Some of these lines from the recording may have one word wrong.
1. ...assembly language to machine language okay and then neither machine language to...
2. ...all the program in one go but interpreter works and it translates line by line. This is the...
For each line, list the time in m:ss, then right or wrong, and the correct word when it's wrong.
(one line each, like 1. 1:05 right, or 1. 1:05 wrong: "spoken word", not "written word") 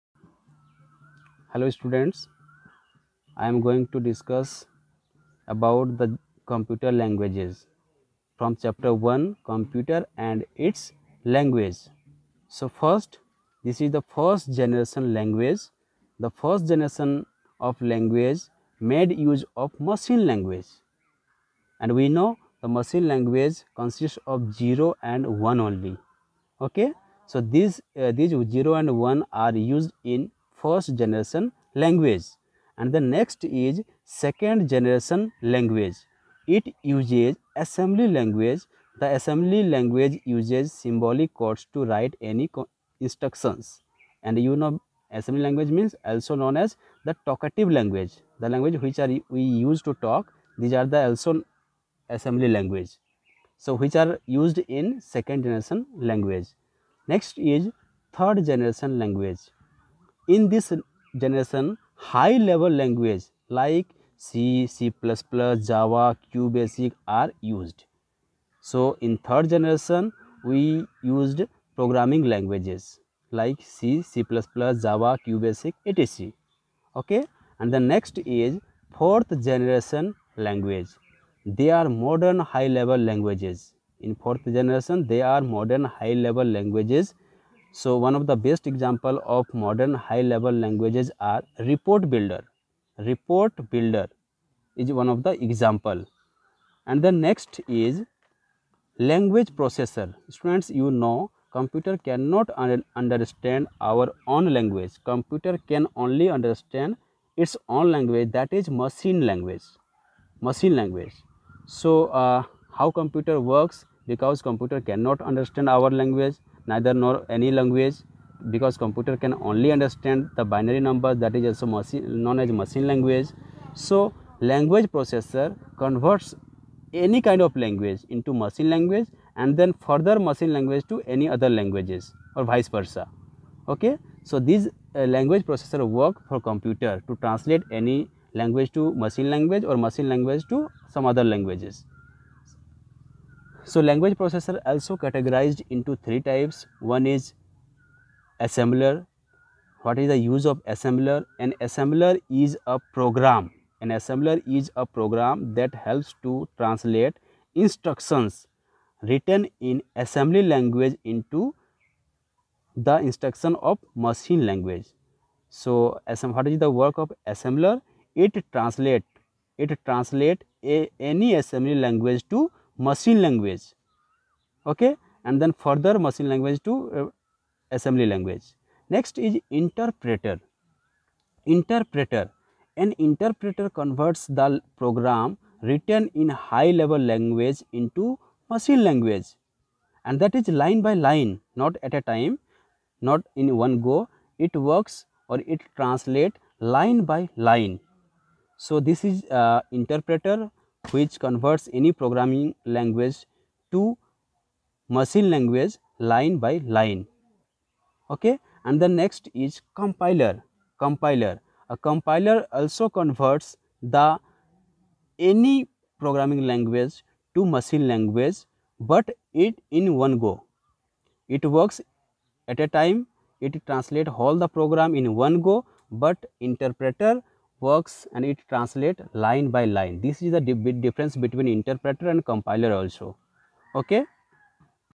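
1. 2:51 wrong: "further", not "neither"
2. 3:44 right.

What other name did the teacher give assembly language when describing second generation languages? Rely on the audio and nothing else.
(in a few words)
talkative language.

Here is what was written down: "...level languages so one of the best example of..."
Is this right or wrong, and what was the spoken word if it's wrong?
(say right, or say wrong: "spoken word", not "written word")
right.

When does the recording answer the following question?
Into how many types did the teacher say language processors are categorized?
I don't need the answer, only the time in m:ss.
2:25.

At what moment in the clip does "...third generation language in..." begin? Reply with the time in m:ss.
0:58.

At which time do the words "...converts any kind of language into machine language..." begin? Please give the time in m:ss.
2:05.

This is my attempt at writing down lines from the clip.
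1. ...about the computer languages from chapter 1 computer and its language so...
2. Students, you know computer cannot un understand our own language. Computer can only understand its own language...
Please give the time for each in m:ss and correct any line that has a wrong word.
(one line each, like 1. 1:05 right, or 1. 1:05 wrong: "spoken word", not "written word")
1. 0:05 right
2. 1:40 right.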